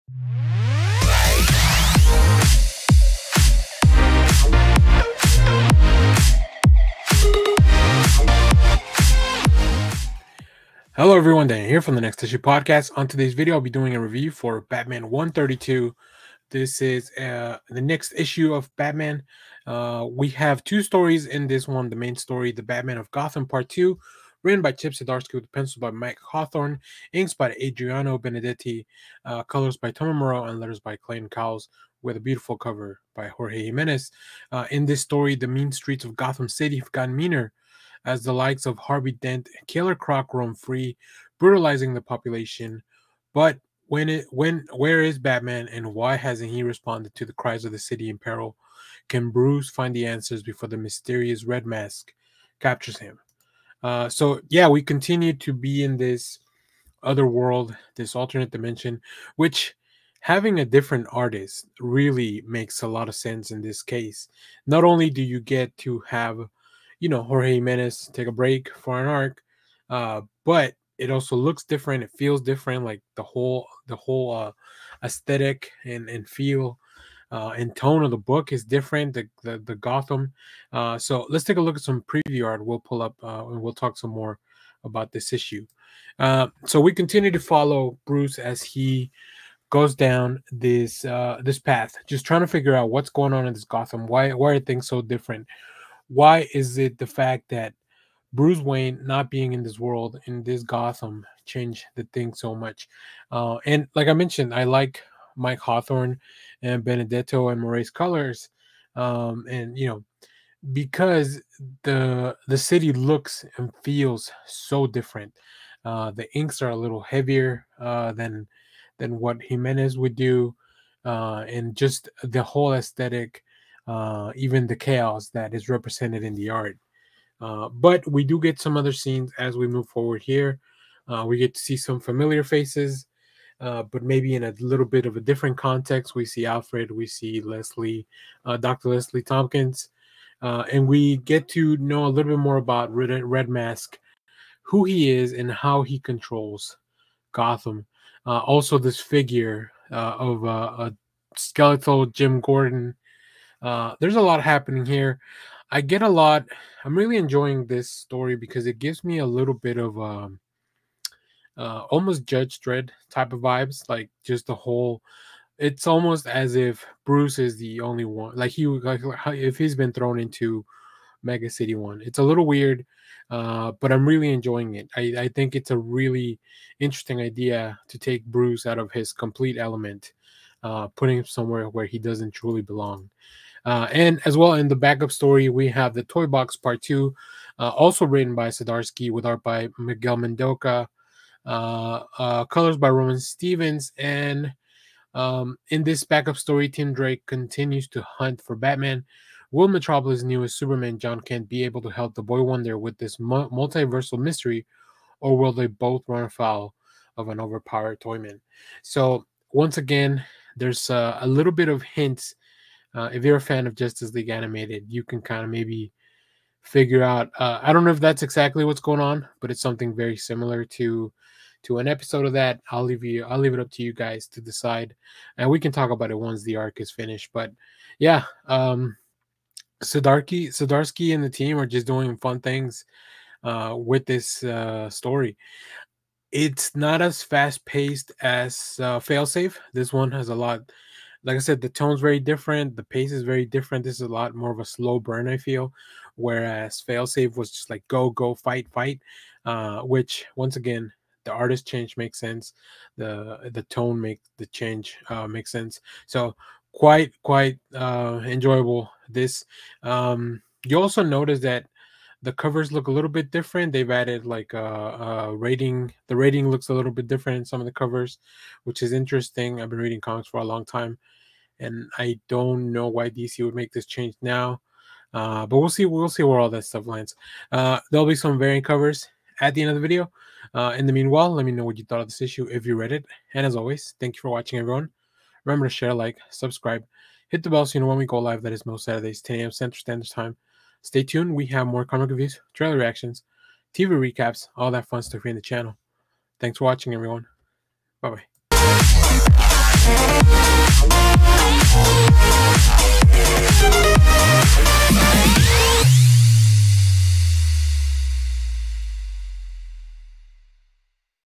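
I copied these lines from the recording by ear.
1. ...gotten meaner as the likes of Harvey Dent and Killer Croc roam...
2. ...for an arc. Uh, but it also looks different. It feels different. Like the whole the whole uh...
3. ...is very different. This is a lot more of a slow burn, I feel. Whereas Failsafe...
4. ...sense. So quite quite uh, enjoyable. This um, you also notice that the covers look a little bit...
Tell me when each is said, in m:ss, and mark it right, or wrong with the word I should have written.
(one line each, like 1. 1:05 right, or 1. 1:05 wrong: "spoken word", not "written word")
1. 0:36 right
2. 1:08 right
3. 4:03 right
4. 4:15 right.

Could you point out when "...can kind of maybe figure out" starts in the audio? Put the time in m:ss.
3:35.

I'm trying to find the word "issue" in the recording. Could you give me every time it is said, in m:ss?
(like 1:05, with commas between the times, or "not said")
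0:12, 0:18, 1:25, 4:42.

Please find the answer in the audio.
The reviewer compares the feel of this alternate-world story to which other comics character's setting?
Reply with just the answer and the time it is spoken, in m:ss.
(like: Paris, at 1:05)
Judge Dredd, at 2:42.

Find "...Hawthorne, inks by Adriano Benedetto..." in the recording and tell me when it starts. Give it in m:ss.
0:26.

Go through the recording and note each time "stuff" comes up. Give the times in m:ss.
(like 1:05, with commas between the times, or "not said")
4:36, 4:55.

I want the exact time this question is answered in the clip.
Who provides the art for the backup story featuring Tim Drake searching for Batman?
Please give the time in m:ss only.
3:09.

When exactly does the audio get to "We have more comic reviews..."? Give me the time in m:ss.
4:51.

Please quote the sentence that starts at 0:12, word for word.
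On today's video, I'll be doing a review for Batman 132.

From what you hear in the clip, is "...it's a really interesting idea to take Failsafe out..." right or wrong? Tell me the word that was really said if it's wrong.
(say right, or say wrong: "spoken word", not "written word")
wrong: "Bruce", not "Failsafe".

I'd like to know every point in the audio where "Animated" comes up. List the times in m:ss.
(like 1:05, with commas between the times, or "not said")
3:34.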